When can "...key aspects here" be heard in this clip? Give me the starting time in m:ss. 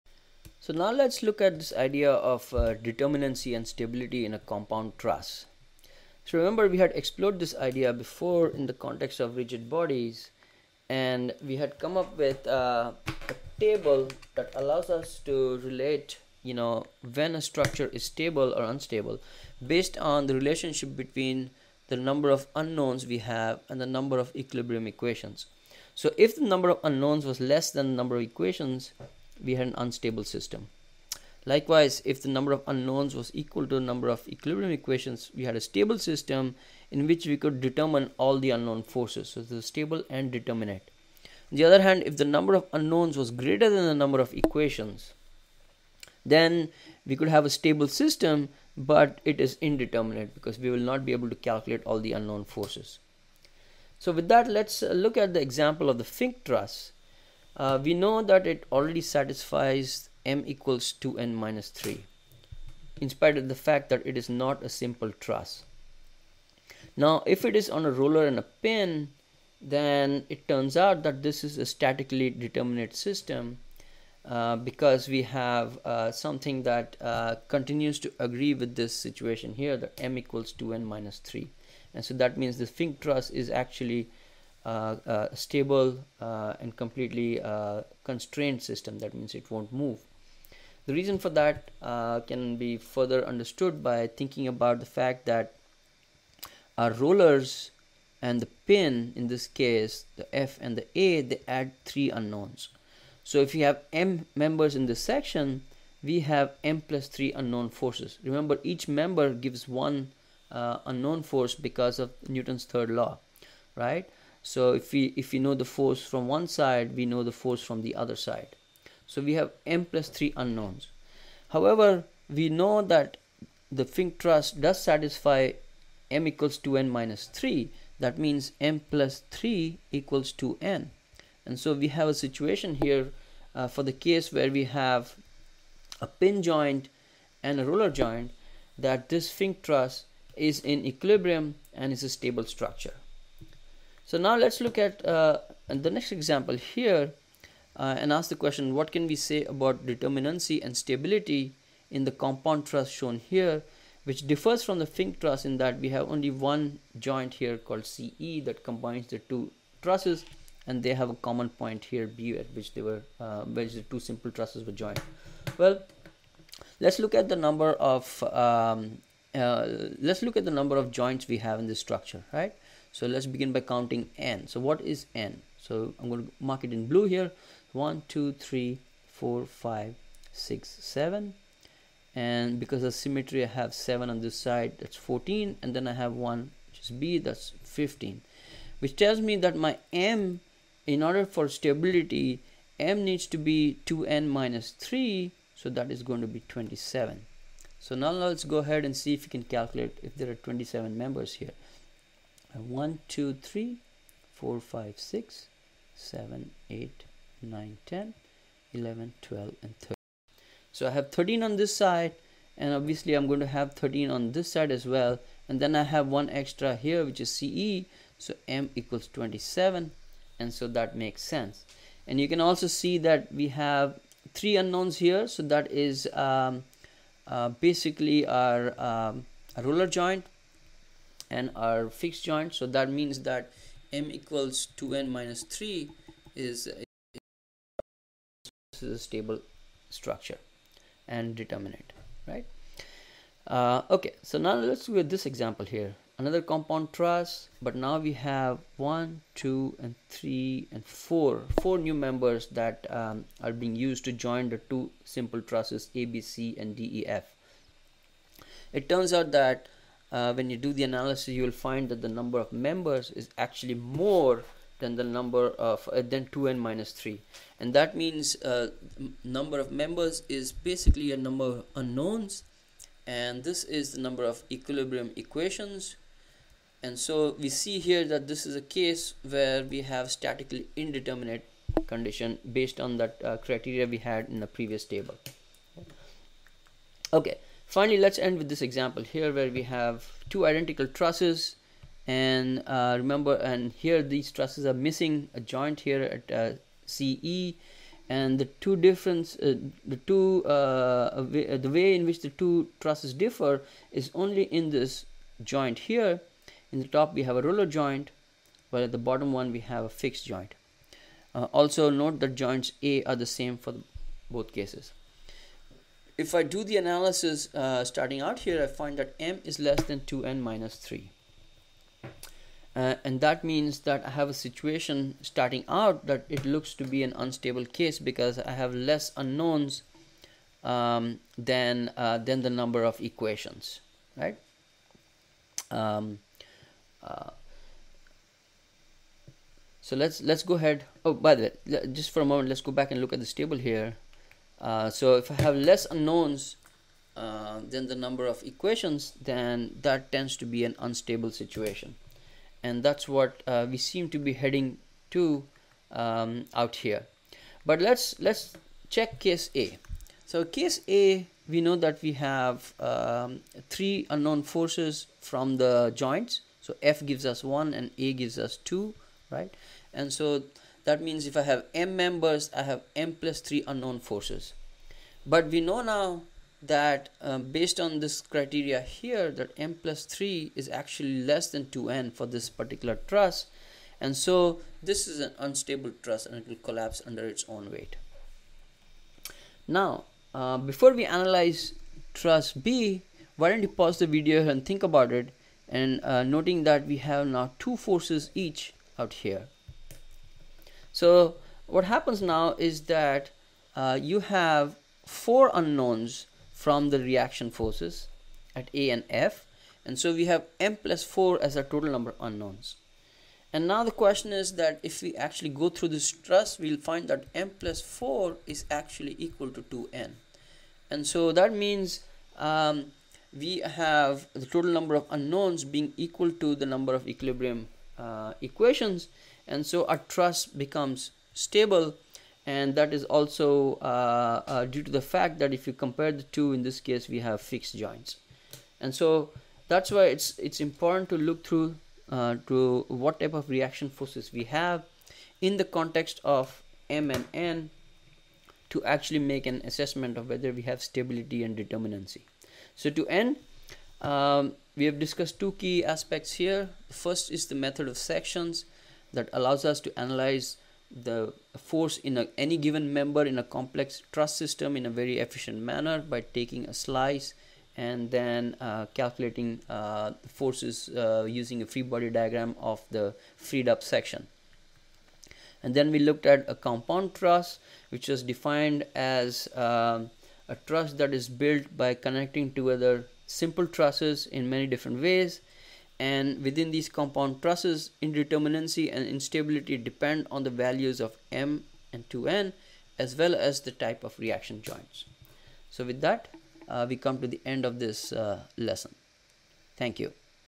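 7:35.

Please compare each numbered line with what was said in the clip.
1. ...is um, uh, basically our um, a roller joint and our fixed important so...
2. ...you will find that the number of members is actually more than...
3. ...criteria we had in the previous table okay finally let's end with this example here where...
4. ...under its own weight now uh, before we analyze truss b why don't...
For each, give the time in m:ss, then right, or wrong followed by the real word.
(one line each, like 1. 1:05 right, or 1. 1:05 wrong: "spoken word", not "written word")
1. 3:45 wrong: "joint", not "important"
2. 4:21 right
3. 4:43 right
4. 6:27 right.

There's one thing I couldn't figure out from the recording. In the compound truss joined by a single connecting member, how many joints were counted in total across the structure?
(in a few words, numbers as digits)
15.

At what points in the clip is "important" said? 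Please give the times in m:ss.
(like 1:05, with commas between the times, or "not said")
7:20.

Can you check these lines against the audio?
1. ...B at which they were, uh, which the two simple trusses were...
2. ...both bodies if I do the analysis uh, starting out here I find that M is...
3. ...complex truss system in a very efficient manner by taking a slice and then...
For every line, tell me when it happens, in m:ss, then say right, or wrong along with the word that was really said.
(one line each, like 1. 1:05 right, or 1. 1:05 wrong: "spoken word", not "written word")
1. 2:42 right
2. 5:14 wrong: "cases", not "bodies"
3. 7:43 right.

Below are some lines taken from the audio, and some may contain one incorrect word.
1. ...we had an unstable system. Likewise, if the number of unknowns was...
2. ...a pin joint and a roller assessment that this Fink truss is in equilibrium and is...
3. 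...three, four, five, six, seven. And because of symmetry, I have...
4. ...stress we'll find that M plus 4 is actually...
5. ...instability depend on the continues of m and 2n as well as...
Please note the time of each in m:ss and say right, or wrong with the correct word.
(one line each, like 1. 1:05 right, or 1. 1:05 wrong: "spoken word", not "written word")
1. 0:29 right
2. 2:16 wrong: "joint", not "assessment"
3. 2:58 right
4. 6:56 right
5. 8:09 wrong: "values", not "continues".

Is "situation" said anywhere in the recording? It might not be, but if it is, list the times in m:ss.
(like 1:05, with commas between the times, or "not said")
1:18, 2:12, 5:24, 5:51.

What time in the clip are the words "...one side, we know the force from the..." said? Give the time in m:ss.
1:56.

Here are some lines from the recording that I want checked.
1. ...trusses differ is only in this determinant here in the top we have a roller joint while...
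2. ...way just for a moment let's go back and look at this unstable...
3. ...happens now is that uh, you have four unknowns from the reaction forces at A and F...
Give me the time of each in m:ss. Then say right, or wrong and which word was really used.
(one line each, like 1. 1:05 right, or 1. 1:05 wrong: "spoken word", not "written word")
1. 5:02 wrong: "joint", not "determinant"
2. 5:41 wrong: "table", not "unstable"
3. 6:41 right.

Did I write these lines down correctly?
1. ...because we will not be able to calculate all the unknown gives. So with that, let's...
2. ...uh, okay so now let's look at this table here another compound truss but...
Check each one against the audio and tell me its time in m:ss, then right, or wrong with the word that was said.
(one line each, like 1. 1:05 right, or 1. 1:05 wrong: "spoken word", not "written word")
1. 0:50 wrong: "forces", not "gives"
2. 4:03 wrong: "example", not "table".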